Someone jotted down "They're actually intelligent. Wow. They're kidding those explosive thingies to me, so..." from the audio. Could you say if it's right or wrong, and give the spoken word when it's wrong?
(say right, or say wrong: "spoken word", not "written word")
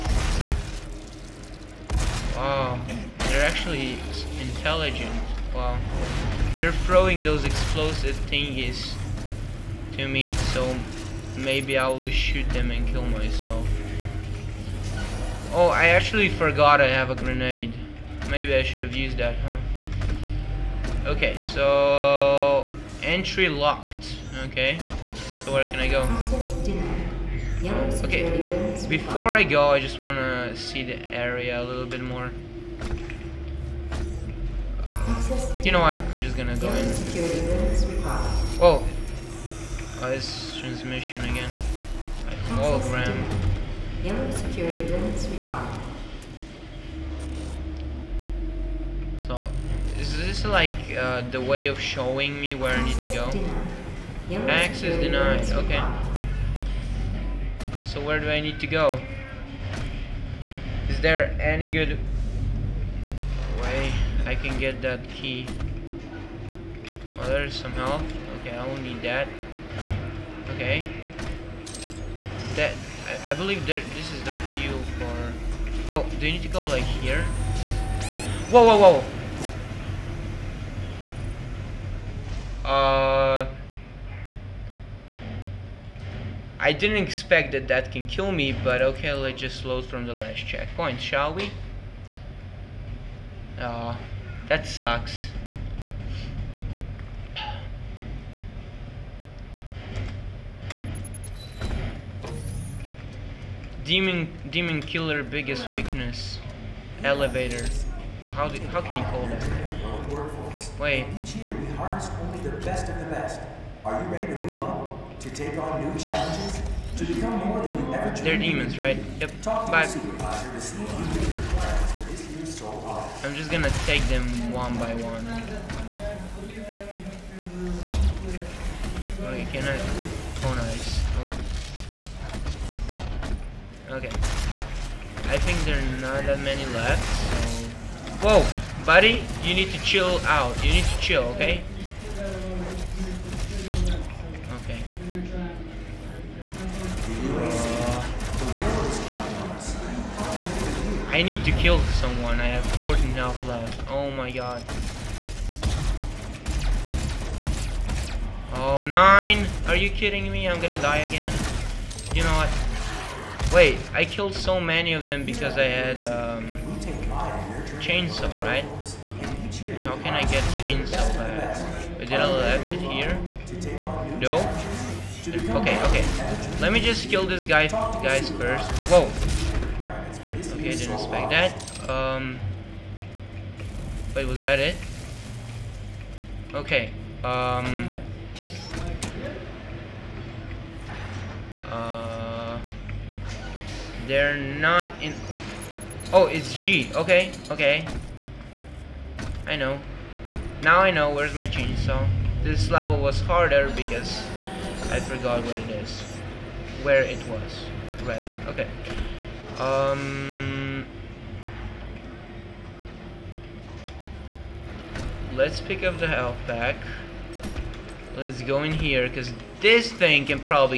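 wrong: "throwing", not "kidding".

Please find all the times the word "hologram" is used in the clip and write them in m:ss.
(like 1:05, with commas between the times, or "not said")
0:42.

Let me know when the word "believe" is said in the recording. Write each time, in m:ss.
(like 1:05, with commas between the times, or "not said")
1:13.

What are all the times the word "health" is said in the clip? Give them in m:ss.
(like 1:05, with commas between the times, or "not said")
2:33, 3:36.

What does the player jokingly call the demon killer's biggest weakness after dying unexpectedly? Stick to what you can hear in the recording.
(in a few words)
elevator.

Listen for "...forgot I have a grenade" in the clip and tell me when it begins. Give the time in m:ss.
0:16.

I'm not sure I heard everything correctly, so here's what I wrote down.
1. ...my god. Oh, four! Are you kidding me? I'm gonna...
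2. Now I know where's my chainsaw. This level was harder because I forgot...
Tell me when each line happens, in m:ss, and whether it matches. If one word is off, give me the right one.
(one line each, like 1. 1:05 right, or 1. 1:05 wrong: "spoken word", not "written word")
1. 2:34 wrong: "nine", not "four"
2. 3:20 right.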